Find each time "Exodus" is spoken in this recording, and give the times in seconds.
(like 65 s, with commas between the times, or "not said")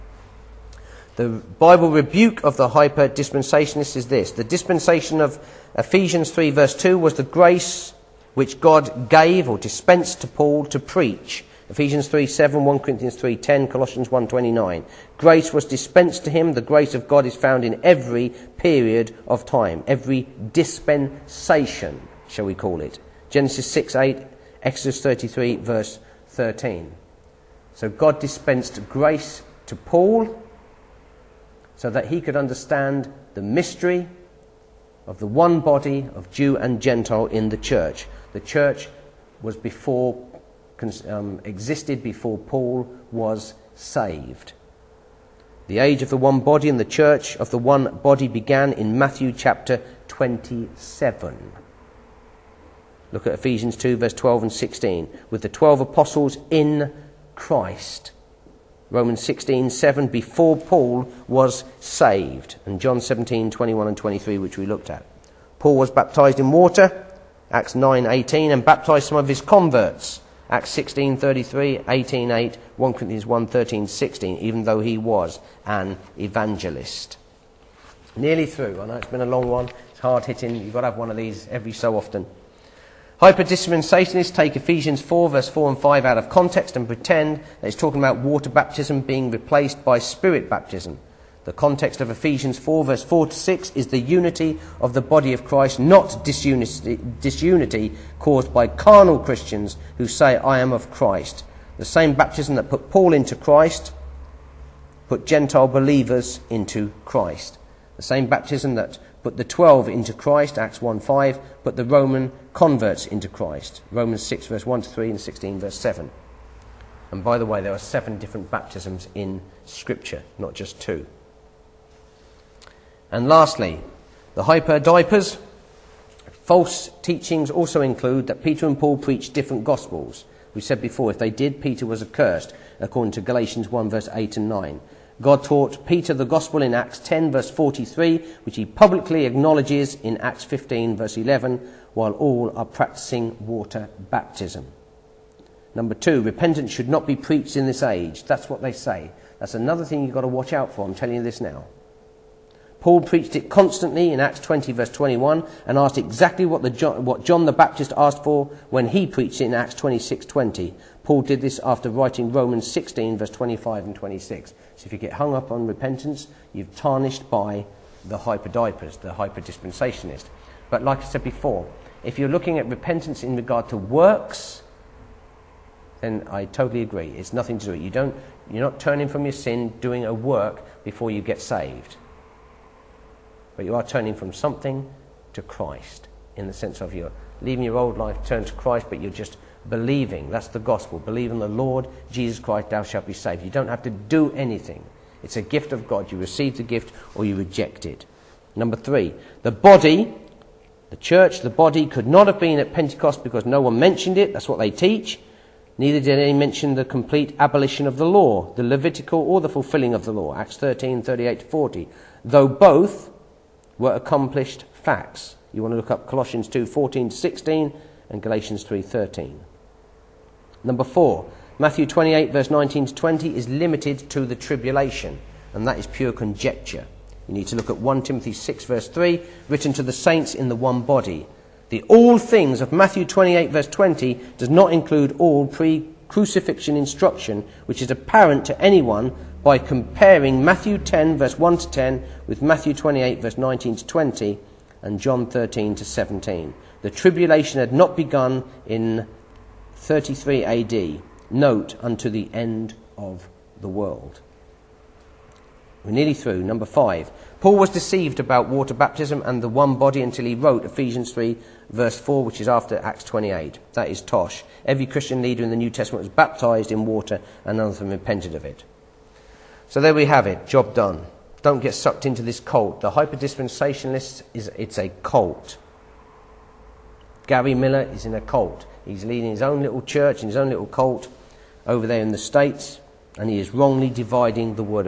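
24 s.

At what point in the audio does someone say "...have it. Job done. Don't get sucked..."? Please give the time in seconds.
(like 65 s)
270 s.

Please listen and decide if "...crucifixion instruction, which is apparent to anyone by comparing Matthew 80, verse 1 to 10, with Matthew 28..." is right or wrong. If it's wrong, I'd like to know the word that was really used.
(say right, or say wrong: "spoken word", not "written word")
wrong: "10", not "80".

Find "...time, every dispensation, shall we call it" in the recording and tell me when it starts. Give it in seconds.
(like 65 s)
19 s.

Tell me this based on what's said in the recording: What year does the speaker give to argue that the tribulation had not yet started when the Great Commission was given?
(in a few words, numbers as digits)
33 AD.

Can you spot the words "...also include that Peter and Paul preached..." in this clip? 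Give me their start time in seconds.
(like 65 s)
127 s.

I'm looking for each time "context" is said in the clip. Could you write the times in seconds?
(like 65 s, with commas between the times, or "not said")
86 s, 91 s.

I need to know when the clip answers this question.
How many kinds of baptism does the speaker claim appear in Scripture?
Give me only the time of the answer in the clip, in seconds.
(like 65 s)
117 s.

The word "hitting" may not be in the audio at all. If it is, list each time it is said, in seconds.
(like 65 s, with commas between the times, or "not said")
80 s.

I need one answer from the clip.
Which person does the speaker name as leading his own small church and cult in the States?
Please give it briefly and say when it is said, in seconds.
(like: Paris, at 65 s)
Gary Miller, at 277 s.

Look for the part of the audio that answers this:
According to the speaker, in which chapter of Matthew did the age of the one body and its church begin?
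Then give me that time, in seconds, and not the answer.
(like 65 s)
48 s.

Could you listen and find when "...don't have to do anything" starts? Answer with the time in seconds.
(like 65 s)
193 s.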